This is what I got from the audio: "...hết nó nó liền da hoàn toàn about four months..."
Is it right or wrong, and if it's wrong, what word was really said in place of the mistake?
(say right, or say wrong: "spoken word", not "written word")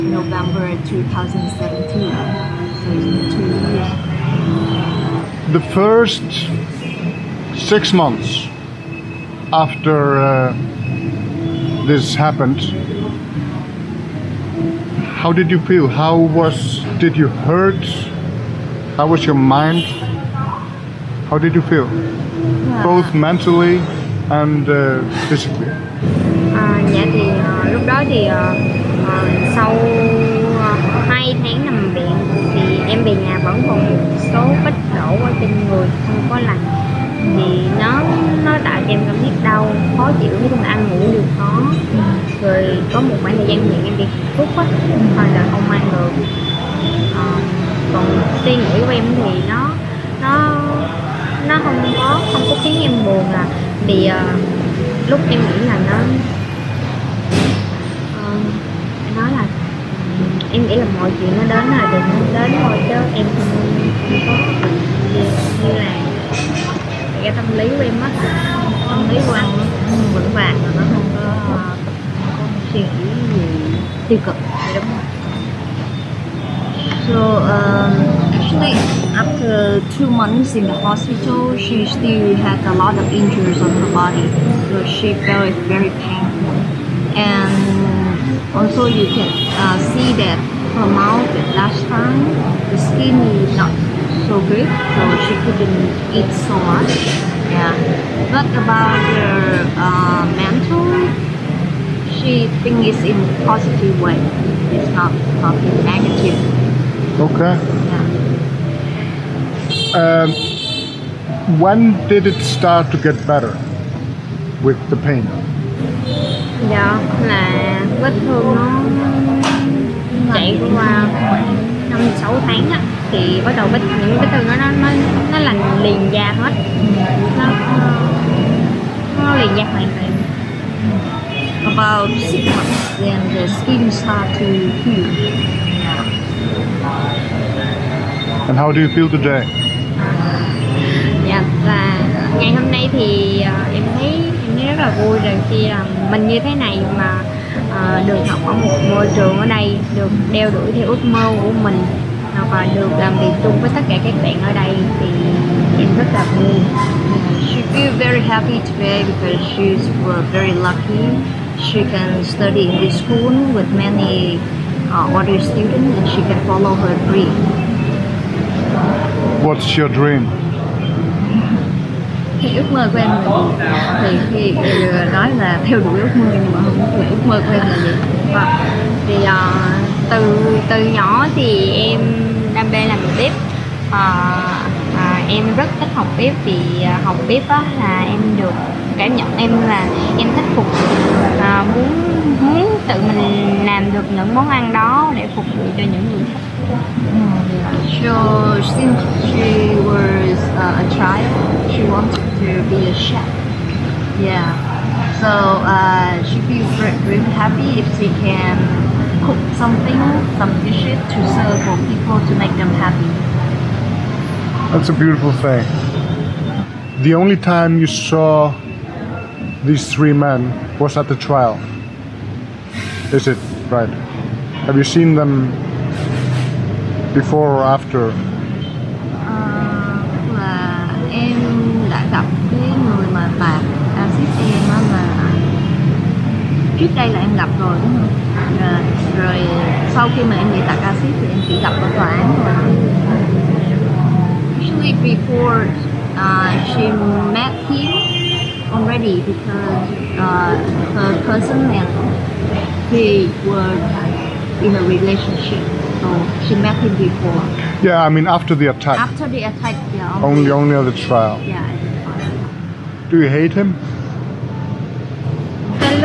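wrong: "six", not "four".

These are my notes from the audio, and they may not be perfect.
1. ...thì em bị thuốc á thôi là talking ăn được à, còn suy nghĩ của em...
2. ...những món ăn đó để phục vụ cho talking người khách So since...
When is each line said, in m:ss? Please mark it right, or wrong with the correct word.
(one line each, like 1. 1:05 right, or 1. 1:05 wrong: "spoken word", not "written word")
1. 0:43 wrong: "không", not "talking"
2. 3:14 wrong: "những", not "talking".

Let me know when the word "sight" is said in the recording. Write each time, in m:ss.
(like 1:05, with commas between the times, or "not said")
not said.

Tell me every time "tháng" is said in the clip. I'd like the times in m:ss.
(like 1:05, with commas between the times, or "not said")
0:31, 2:02.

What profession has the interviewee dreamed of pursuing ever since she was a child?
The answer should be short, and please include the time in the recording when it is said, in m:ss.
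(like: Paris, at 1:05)
chef, at 3:22.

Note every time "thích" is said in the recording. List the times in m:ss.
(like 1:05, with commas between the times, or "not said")
3:05, 3:10.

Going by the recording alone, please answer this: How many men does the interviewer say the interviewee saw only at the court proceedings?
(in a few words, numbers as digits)
3.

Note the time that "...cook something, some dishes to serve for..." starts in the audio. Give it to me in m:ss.
3:29.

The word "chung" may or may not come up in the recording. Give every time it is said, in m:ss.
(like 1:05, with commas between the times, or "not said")
0:40, 2:33.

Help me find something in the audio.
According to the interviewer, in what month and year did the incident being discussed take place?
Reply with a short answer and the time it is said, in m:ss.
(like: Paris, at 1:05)
November 2017, at 0:00.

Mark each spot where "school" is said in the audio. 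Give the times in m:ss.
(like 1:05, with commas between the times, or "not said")
2:43.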